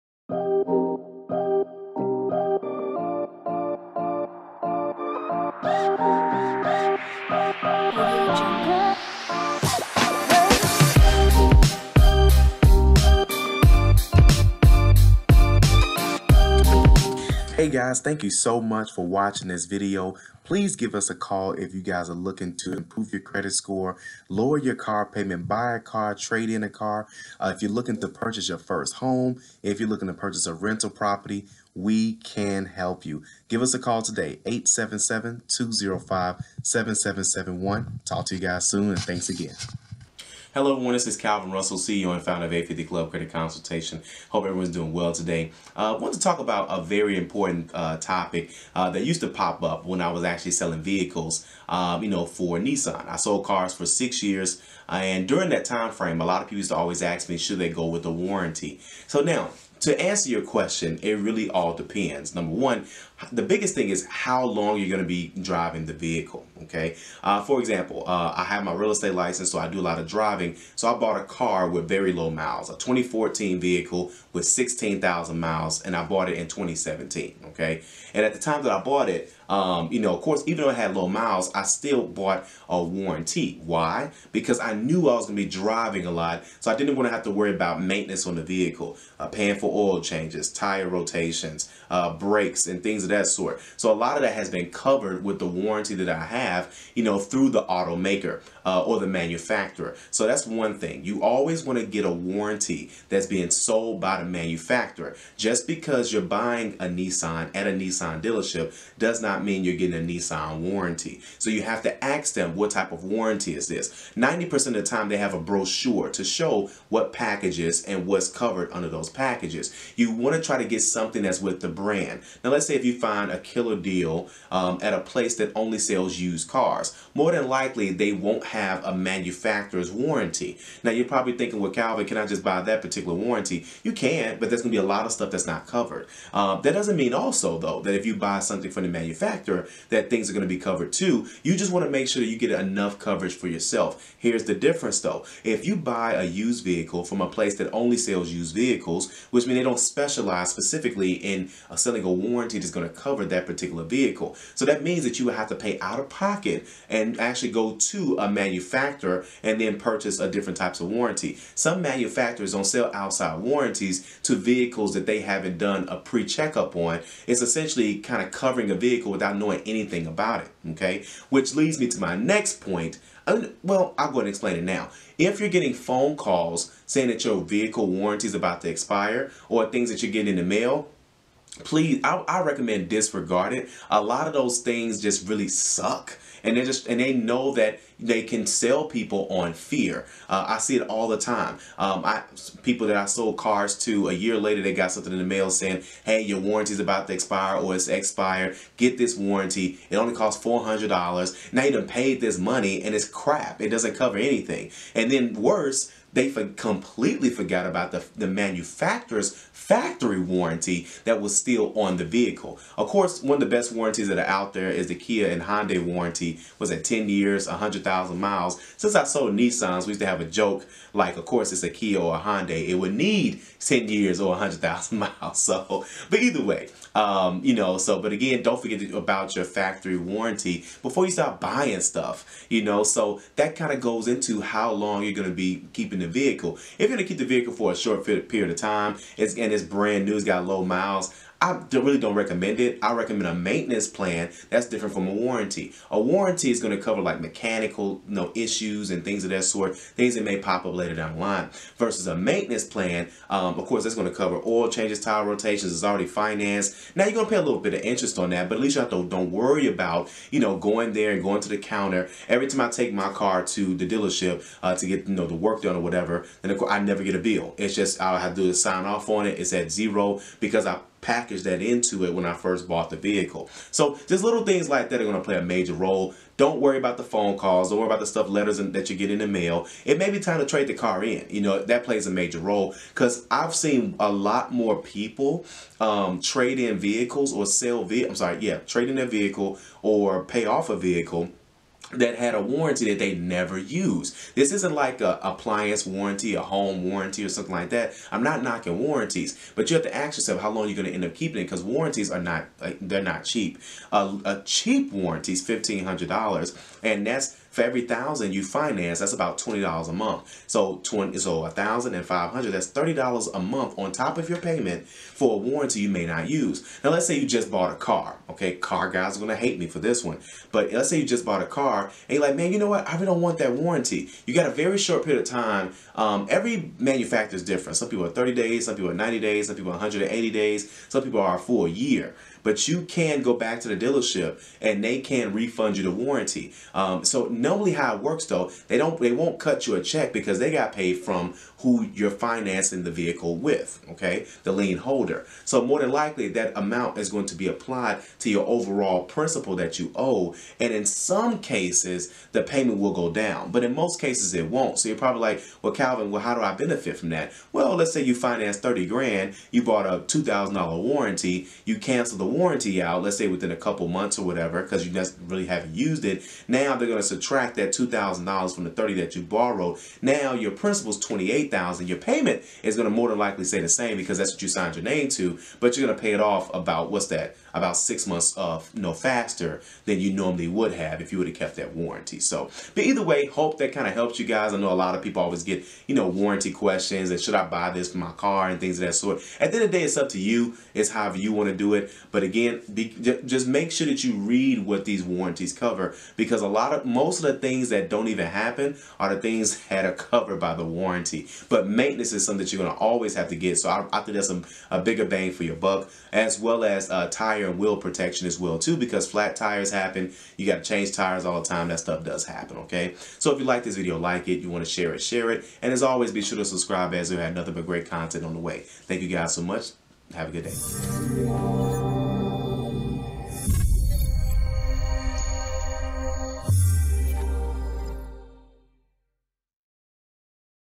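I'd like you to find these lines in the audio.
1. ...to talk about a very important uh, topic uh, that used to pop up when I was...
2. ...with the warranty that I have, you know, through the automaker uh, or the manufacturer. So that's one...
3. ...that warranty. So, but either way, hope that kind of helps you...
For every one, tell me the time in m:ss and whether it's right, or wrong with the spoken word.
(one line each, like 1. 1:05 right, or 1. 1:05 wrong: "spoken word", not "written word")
1. 0:46 right
2. 1:35 right
3. 6:21 right.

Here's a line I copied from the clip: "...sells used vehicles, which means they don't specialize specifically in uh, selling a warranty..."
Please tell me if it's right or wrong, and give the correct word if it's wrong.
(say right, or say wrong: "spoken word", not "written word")
right.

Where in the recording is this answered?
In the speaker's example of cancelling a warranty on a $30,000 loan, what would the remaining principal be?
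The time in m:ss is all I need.
6:10.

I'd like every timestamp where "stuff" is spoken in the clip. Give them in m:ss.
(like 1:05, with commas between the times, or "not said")
2:15, 3:51, 4:38, 6:51.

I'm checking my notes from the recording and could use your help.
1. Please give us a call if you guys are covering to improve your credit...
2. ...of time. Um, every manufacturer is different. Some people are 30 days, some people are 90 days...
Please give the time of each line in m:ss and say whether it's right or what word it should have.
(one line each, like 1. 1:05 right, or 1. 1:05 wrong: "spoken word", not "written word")
1. 0:20 wrong: "looking", not "covering"
2. 5:25 right.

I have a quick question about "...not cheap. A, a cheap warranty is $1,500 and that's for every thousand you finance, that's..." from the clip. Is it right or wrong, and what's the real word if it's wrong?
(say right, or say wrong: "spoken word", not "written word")
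right.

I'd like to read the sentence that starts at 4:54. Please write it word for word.
This isn't like a appliance warranty, a home warranty or something like that.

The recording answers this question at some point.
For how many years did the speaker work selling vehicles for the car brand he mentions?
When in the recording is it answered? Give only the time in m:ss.
0:53.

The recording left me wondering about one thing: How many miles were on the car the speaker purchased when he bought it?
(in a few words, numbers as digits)
16,000.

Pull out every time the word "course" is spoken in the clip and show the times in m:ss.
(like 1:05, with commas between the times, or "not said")
1:20, 3:32, 3:41, 4:13, 4:26.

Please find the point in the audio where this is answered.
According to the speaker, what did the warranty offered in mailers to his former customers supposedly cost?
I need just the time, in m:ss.
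3:20.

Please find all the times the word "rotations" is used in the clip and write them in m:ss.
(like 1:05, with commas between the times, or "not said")
1:30, 4:15.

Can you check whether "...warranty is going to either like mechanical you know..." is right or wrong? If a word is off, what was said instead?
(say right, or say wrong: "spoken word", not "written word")
wrong: "cover", not "either".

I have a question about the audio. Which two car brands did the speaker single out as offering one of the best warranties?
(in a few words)
Kia and Hyundai.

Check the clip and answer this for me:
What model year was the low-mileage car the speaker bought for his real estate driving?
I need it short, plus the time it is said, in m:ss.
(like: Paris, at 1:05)
2014, at 1:12.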